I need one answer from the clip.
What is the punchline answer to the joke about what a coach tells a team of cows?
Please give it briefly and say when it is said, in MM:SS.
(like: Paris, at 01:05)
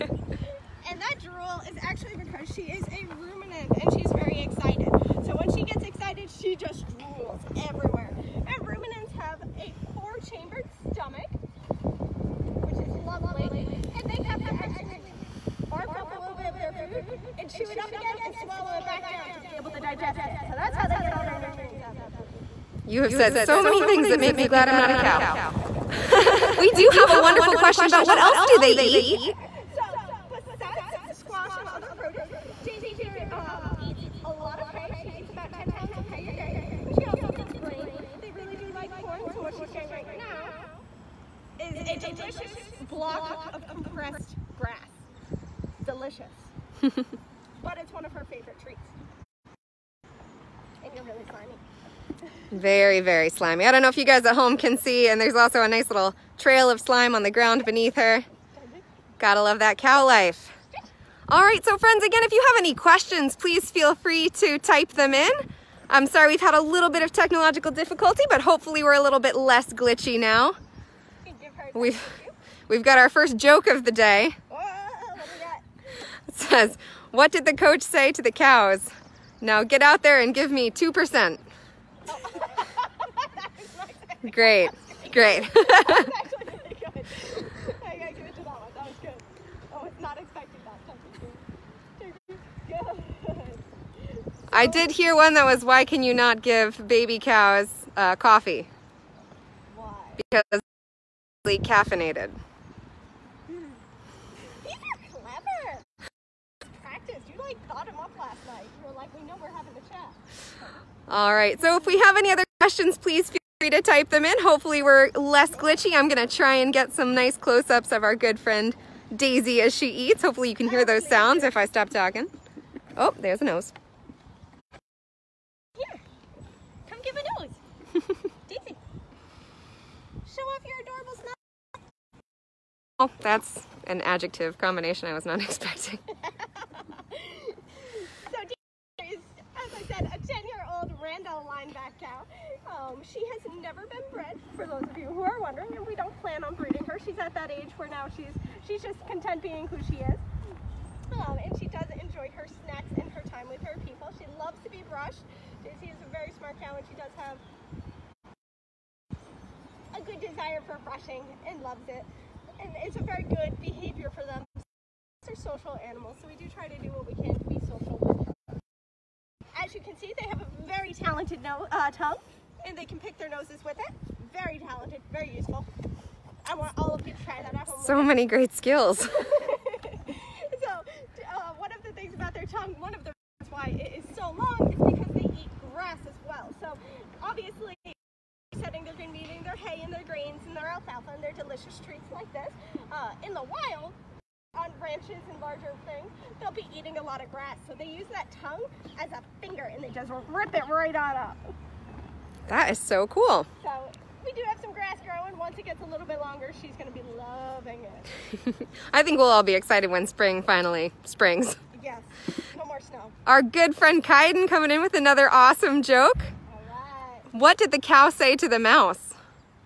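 Give me 2%, at 01:20.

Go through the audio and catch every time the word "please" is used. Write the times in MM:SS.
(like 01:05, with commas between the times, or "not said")
01:03, 01:52.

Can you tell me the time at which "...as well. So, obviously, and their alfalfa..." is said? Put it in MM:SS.
03:06.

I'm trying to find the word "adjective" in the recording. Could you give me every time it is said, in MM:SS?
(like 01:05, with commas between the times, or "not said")
02:14.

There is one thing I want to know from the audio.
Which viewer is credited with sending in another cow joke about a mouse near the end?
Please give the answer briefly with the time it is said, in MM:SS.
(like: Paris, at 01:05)
Kaiden, at 03:34.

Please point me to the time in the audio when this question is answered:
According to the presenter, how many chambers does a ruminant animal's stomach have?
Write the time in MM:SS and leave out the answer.
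00:09.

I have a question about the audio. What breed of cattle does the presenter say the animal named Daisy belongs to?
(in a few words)
Randall lineback.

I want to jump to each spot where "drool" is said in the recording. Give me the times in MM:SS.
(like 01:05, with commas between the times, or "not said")
00:01, 00:06.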